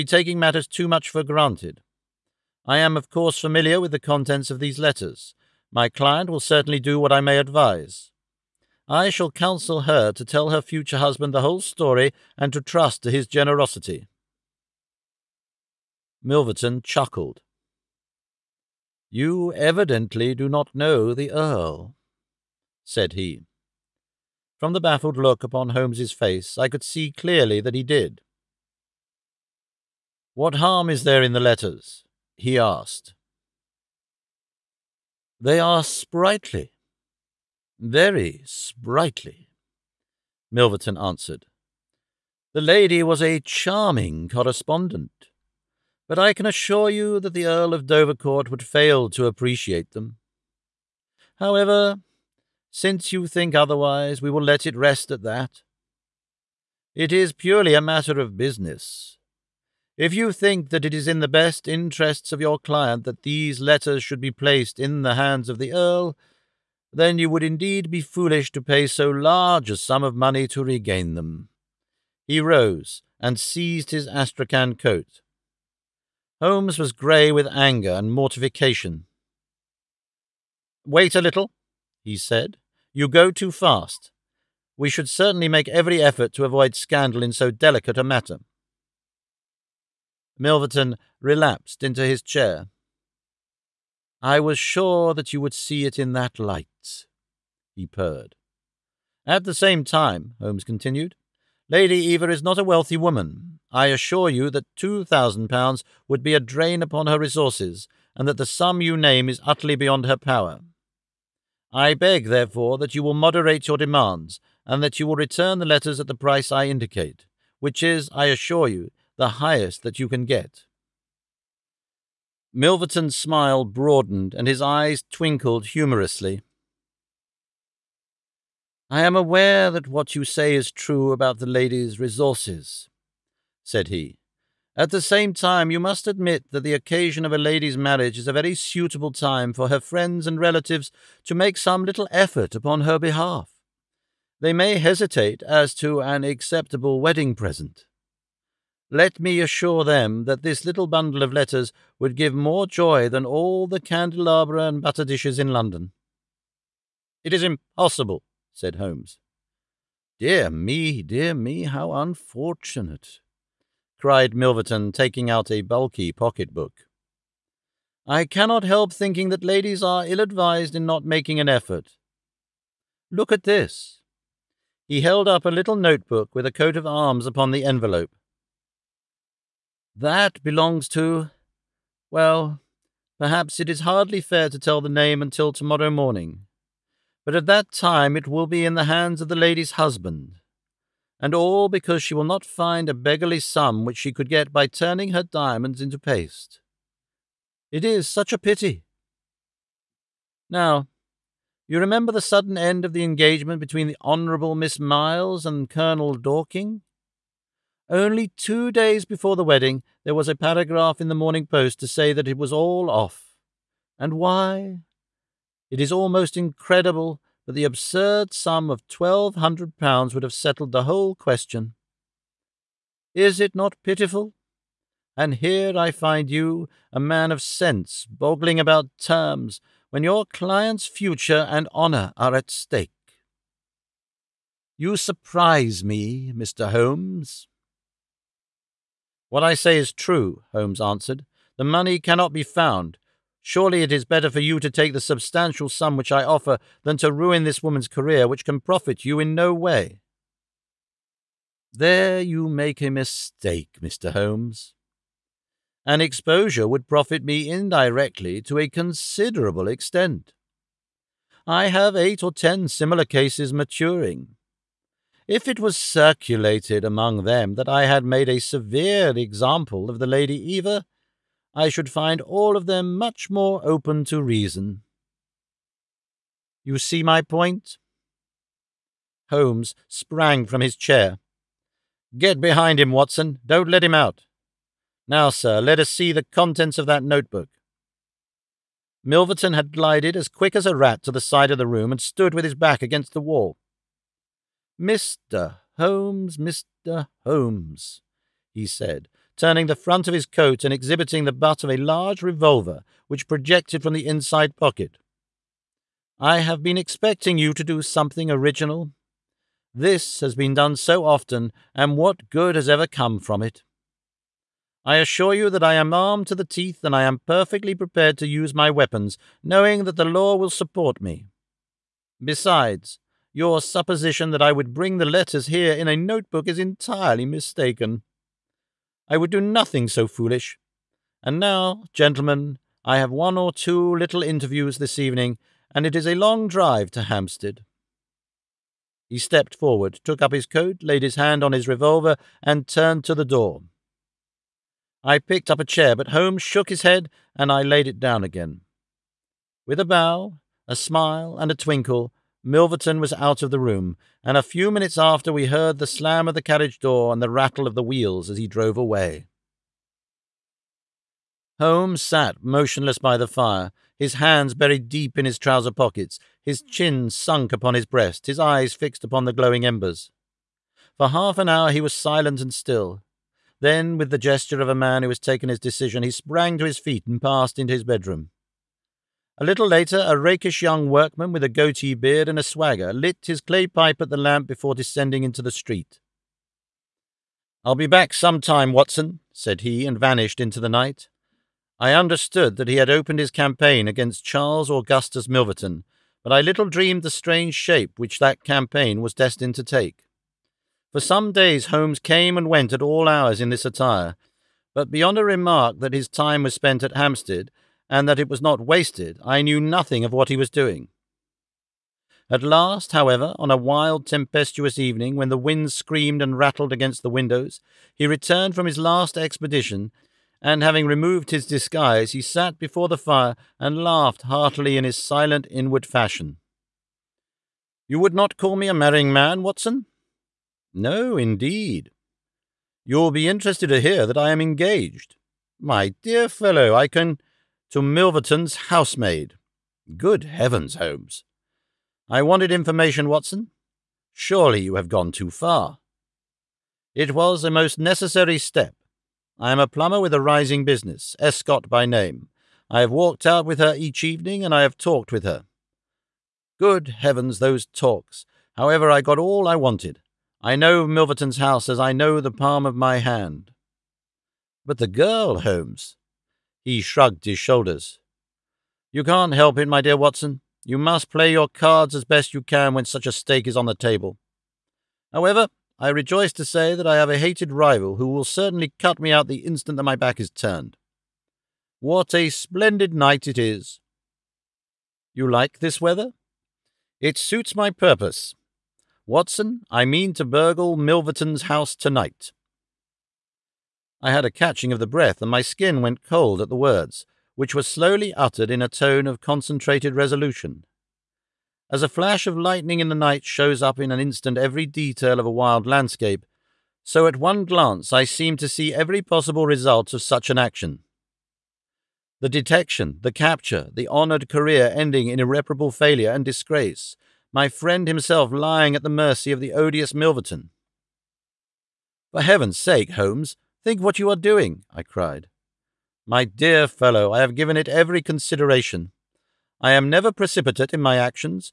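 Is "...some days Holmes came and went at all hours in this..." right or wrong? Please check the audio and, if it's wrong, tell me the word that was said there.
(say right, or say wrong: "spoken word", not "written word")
right.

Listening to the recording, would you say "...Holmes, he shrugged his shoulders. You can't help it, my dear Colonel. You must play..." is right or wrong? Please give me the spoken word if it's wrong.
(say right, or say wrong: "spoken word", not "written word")
wrong: "Watson", not "Colonel".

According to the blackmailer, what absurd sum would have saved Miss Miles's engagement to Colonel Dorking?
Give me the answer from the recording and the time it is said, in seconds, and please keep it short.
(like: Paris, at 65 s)
1200 pounds, at 218 s.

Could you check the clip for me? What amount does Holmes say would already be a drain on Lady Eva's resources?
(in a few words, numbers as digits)
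2000 pounds.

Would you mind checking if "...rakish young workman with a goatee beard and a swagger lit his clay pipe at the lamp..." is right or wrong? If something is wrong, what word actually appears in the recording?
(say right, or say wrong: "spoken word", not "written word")
right.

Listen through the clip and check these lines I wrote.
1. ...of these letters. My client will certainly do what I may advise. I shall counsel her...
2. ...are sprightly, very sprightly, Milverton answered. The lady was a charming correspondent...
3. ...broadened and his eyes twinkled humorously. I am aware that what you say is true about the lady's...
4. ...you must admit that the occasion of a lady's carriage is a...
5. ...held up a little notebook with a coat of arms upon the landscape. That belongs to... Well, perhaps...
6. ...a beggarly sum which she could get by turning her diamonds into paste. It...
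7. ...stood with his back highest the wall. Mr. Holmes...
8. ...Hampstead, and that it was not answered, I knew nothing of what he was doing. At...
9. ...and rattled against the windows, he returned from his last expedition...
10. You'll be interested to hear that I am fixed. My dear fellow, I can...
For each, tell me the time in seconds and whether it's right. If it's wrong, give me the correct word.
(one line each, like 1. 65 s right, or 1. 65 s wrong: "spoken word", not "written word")
1. 4 s right
2. 35 s right
3. 123 s right
4. 135 s wrong: "marriage", not "carriage"
5. 175 s wrong: "envelope", not "landscape"
6. 192 s right
7. 291 s wrong: "against", not "highest"
8. 406 s wrong: "wasted", not "answered"
9. 416 s right
10. 432 s wrong: "engaged", not "fixed".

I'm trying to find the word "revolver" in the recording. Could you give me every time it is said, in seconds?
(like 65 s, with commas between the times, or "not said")
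302 s, 341 s.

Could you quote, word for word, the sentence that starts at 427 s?
You would not call me a marrying man, Watson?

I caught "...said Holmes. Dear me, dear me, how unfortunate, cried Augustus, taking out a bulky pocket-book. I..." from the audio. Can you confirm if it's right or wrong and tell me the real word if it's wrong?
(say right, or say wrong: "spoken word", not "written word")
wrong: "Milverton", not "Augustus".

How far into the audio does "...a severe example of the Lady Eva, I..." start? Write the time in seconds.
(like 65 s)
268 s.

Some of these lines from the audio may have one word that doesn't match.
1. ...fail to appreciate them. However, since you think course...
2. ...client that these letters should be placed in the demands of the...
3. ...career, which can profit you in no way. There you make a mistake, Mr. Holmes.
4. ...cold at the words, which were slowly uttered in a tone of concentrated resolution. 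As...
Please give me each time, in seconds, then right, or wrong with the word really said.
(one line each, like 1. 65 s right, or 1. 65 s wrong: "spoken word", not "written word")
1. 48 s wrong: "otherwise", not "course"
2. 62 s wrong: "hands", not "demands"
3. 247 s right
4. 496 s right.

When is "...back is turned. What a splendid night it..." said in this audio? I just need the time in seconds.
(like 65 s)
479 s.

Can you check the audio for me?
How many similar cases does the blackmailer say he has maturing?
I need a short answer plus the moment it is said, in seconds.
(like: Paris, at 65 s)
eight or ten, at 261 s.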